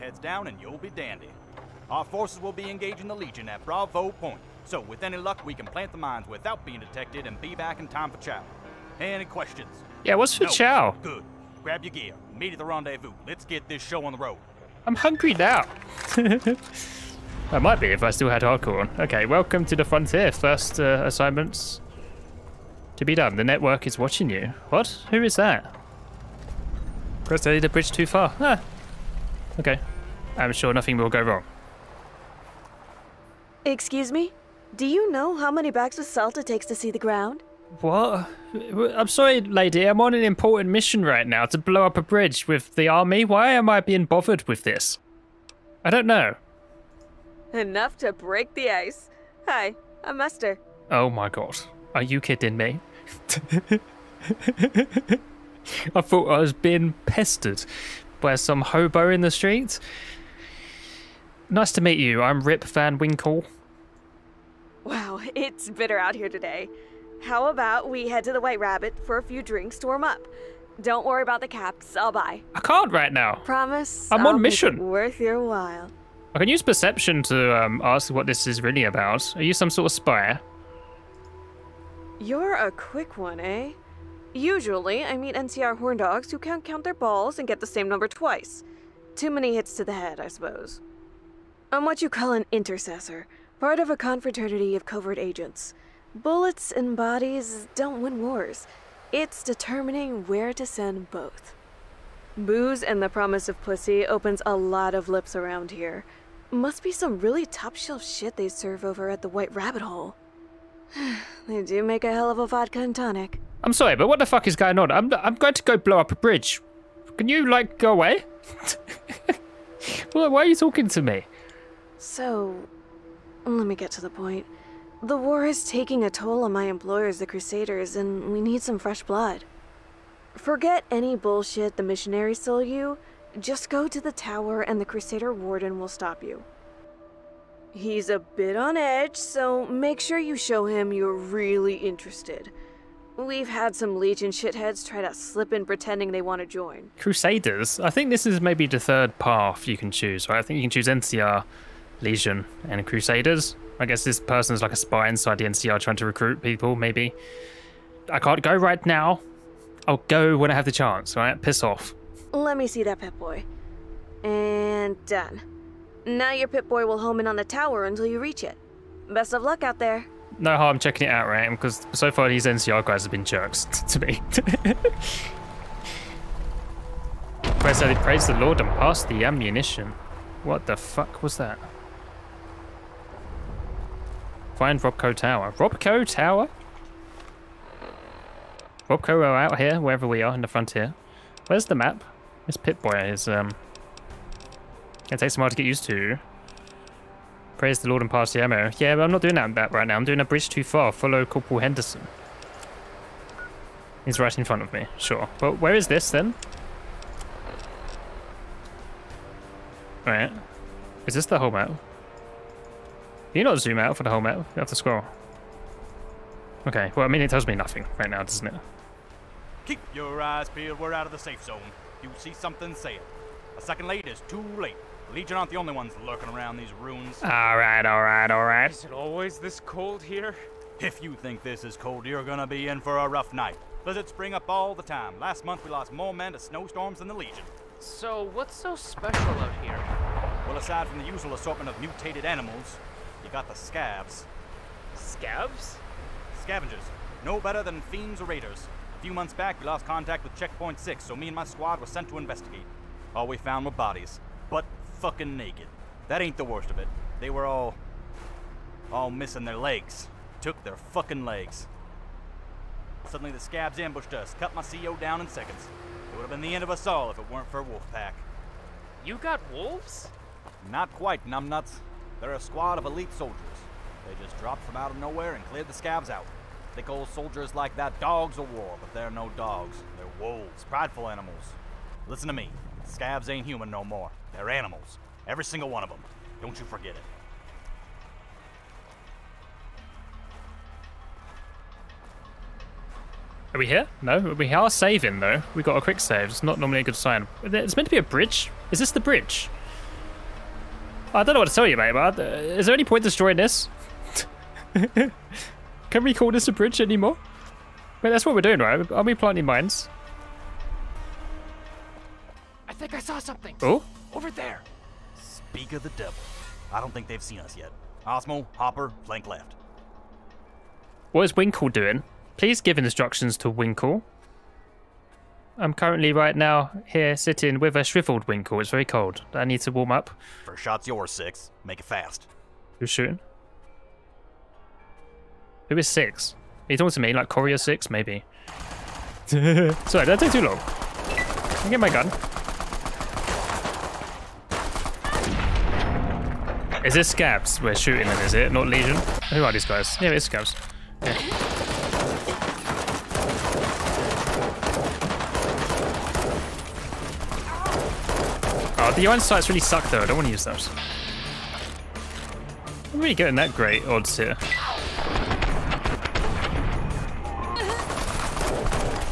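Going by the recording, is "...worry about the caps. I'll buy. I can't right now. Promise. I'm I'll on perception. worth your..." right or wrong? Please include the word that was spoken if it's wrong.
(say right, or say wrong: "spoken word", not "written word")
wrong: "mission", not "perception".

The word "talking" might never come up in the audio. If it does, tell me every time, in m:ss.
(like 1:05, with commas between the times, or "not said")
2:00, 5:36.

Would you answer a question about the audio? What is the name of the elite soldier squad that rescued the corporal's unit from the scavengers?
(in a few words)
Wolfpack.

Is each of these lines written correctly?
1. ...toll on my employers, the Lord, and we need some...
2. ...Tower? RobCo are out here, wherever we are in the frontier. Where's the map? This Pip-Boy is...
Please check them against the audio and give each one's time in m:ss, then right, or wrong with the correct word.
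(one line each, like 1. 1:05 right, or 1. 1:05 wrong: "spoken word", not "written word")
1. 2:06 wrong: "Crusaders", not "Lord"
2. 3:06 right.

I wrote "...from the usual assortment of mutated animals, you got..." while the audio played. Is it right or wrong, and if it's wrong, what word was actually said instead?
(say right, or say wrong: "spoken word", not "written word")
right.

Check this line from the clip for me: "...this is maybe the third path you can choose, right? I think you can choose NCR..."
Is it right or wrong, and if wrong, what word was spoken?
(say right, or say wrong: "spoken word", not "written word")
right.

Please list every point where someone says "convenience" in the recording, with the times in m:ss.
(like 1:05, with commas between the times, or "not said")
not said.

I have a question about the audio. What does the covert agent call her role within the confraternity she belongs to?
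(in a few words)
intercessor.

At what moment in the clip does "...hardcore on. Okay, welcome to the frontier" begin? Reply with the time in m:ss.
0:18.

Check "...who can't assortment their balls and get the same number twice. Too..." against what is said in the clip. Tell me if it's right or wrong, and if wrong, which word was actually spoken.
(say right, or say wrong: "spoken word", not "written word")
wrong: "count", not "assortment".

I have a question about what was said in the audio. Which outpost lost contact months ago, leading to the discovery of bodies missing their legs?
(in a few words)
Checkpoint 6.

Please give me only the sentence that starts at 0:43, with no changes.
Why am I being bothered with this?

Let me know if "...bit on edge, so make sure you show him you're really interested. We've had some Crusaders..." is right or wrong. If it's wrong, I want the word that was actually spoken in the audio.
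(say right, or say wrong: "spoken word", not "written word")
wrong: "Legion", not "Crusaders".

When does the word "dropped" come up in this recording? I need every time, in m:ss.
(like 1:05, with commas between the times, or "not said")
4:34.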